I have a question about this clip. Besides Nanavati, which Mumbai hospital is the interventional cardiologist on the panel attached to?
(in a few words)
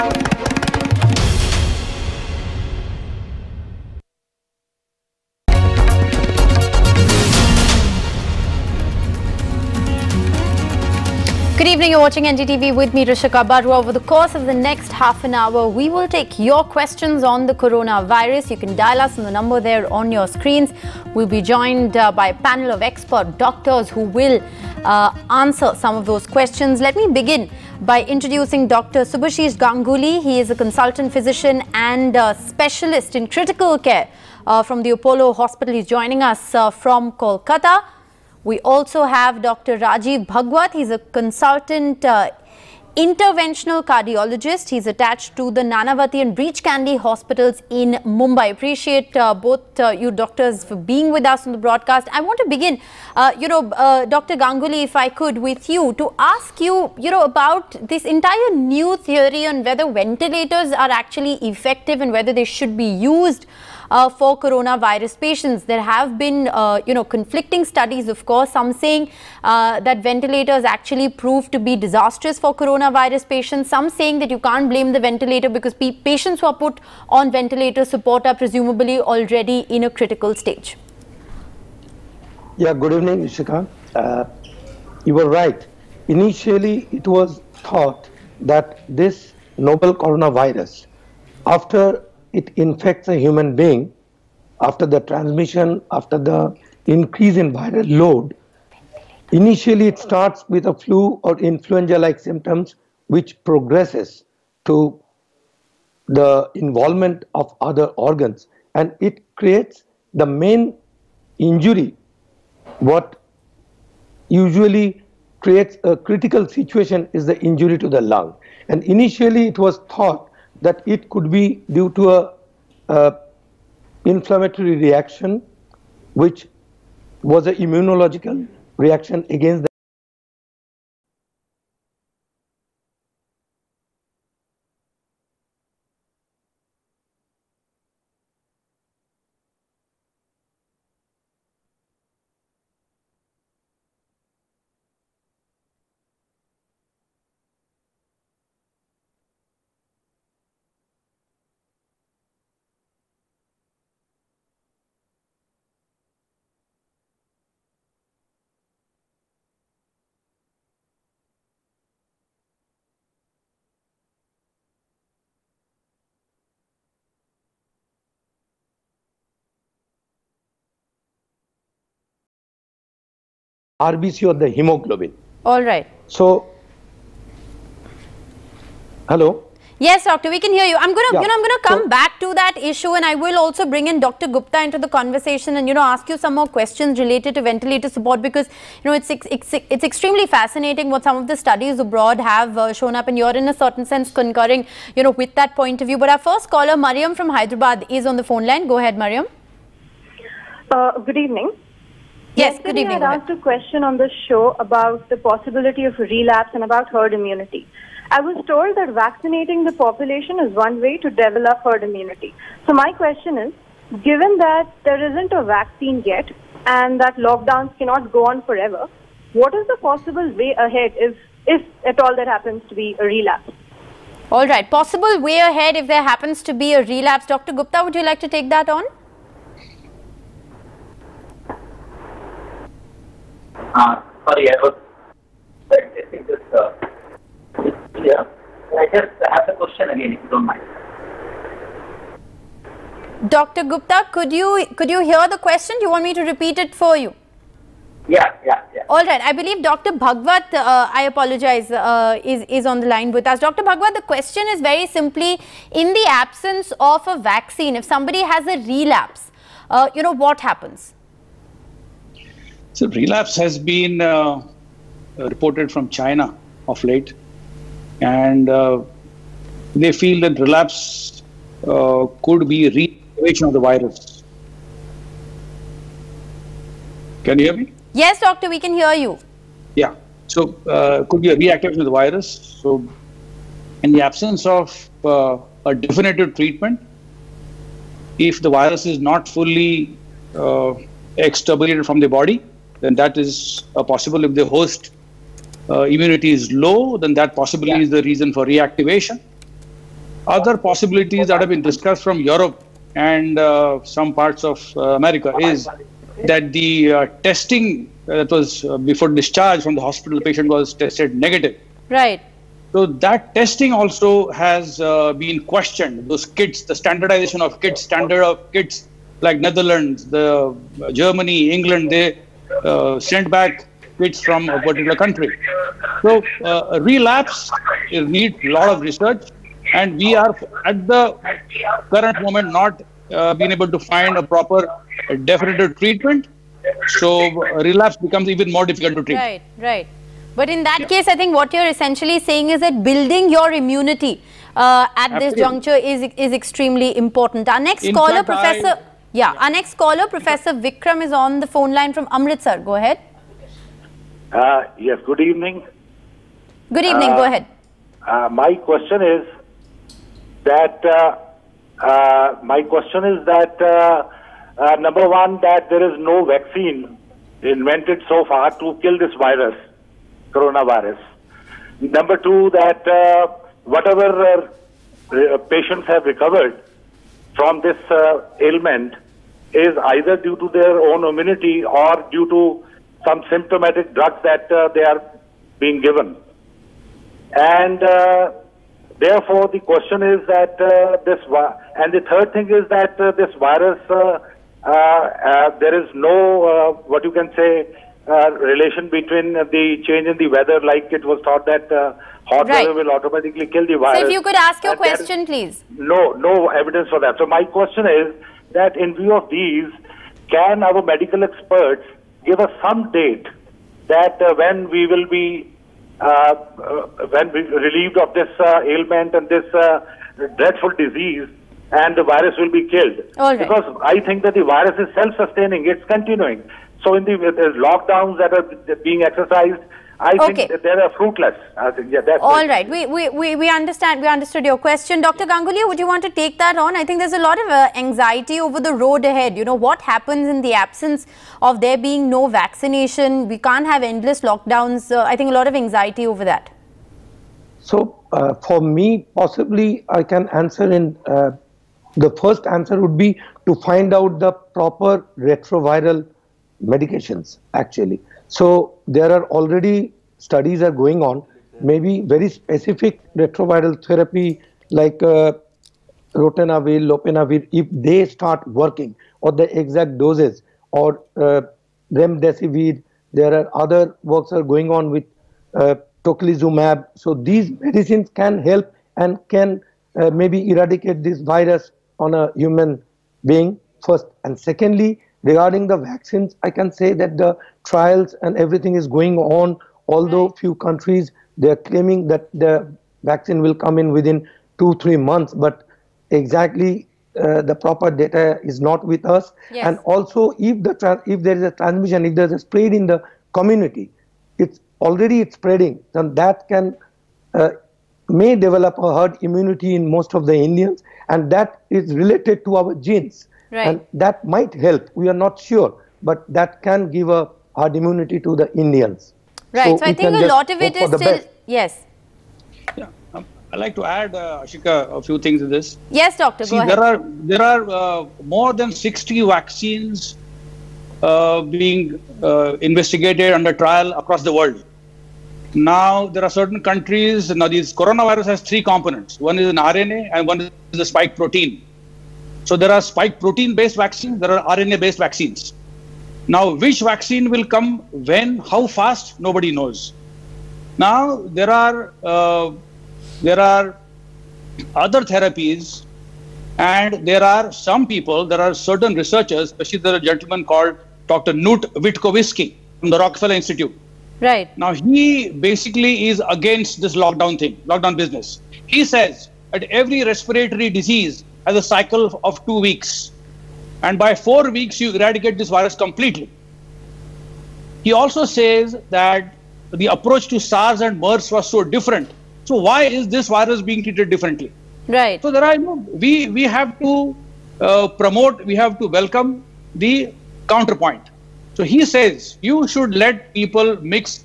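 Breach Candy.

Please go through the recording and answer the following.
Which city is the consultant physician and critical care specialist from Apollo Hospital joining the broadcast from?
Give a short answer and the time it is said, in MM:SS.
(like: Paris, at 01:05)
Kolkata, at 00:37.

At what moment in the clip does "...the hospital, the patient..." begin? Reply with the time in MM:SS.
05:09.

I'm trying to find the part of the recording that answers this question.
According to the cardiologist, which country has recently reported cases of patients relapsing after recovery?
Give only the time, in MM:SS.
04:25.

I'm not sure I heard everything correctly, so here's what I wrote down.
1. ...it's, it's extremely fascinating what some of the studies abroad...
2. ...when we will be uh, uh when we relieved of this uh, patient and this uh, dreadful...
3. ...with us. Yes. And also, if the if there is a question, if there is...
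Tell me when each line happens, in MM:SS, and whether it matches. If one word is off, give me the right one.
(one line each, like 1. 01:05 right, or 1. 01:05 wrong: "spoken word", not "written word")
1. 03:09 right
2. 06:54 wrong: "ailment", not "patient"
3. 08:18 wrong: "transmission", not "question".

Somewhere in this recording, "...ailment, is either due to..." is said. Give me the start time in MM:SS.
06:18.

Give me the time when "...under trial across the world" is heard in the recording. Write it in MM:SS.
08:53.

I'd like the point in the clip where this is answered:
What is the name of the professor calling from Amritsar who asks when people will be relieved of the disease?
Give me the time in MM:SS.
05:50.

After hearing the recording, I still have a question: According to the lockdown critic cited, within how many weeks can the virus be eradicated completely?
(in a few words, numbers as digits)
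4 weeks.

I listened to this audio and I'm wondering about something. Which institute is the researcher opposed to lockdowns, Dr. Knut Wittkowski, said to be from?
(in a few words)
Rockefeller Institute.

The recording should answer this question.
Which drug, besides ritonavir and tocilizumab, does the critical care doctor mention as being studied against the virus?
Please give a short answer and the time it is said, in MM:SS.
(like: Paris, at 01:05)
remdesivir, at 07:51.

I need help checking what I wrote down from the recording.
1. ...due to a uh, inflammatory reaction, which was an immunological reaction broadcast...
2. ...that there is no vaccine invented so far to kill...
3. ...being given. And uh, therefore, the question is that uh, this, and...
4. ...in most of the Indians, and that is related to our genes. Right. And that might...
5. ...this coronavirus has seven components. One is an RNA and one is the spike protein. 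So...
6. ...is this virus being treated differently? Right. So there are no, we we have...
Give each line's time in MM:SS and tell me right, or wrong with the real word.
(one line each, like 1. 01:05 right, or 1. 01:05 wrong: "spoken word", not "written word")
1. 02:01 wrong: "against", not "broadcast"
2. 06:05 right
3. 06:25 right
4. 08:29 right
5. 08:57 wrong: "three", not "seven"
6. 09:42 right.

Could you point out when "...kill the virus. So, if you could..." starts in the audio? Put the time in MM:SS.
06:43.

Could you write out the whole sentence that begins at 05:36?
So relapse becomes even more difficult to treat.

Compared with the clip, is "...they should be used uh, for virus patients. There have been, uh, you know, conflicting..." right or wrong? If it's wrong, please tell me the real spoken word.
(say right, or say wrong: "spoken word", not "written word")
wrong: "coronavirus", not "virus".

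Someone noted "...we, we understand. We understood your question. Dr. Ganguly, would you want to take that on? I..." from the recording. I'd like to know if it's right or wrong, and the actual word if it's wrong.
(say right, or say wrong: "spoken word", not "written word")
right.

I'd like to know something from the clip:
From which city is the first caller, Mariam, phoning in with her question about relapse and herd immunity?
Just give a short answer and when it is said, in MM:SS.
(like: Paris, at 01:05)
Hyderabad, at 03:17.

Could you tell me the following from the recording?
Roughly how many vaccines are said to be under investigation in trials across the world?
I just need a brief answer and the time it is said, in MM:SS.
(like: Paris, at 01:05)
more than 60, at 08:48.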